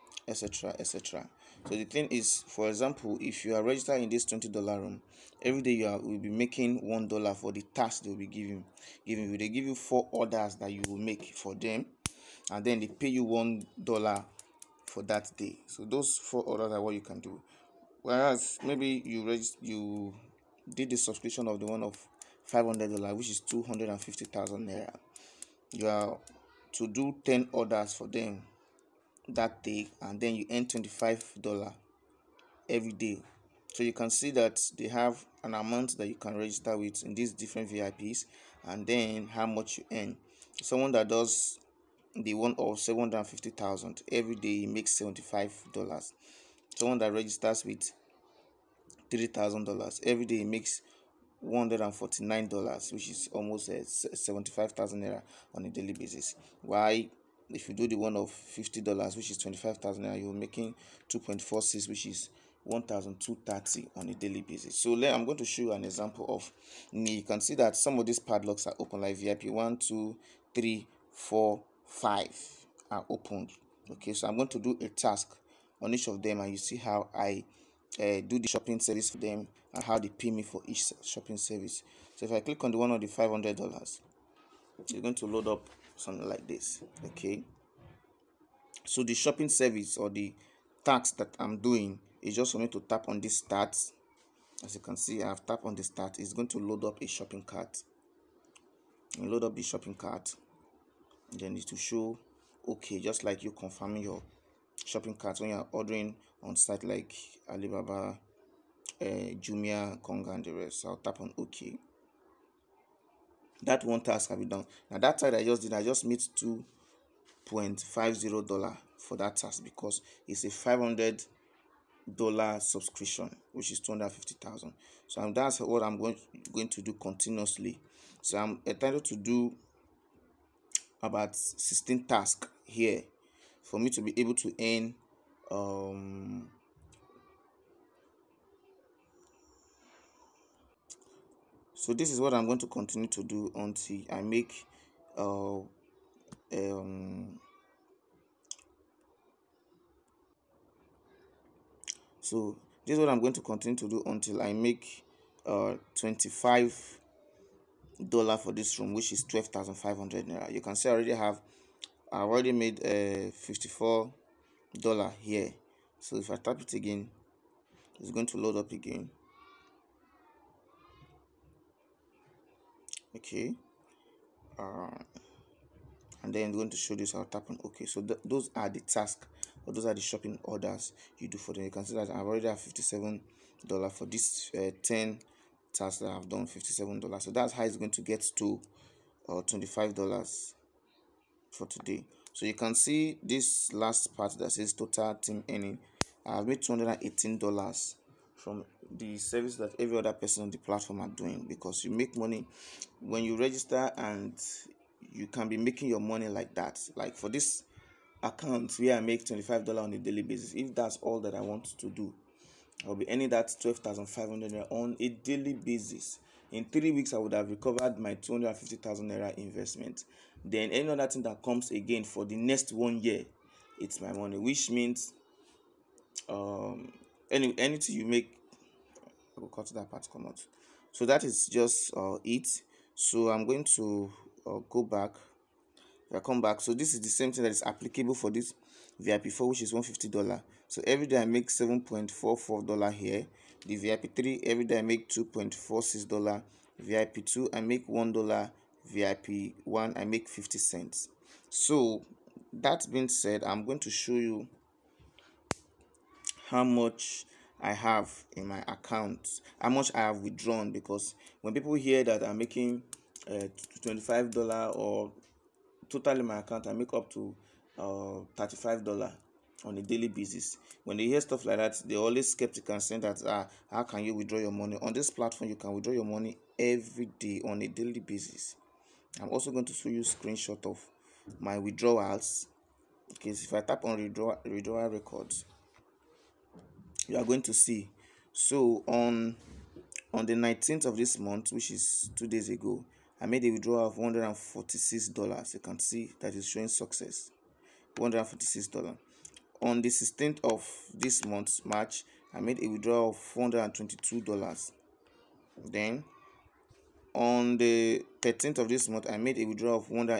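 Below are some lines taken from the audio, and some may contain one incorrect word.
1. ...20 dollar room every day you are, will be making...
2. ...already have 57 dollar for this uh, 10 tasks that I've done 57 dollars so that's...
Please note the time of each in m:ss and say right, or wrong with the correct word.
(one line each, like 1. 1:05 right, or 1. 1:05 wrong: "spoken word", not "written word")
1. 0:04 right
2. 3:02 right.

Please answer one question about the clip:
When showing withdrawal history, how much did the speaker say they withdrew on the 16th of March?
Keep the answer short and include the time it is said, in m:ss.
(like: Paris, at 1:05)
$422, at 5:03.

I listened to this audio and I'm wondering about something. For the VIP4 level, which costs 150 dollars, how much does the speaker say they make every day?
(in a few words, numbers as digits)
$7.44.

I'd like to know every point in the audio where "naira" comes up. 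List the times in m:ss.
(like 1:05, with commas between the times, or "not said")
0:24, 0:55, 1:00, 2:40.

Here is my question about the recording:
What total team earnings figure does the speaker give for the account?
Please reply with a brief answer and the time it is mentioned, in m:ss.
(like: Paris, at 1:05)
$218, at 3:16.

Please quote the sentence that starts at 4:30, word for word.
When they hear stuff like that, they always skeptical and saying that ah, how can you withdraw your money?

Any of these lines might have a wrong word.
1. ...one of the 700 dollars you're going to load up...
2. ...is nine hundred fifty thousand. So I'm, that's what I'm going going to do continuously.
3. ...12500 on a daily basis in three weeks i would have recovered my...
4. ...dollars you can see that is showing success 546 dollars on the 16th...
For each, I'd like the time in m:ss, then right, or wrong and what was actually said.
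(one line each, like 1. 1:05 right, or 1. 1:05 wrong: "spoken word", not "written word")
1. 1:22 wrong: "500", not "700"
2. 2:03 wrong: "two", not "nine"
3. 3:33 right
4. 4:55 wrong: "146", not "546".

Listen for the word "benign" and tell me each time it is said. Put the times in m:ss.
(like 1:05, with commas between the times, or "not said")
not said.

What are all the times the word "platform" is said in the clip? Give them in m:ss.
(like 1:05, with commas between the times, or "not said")
3:20, 4:35.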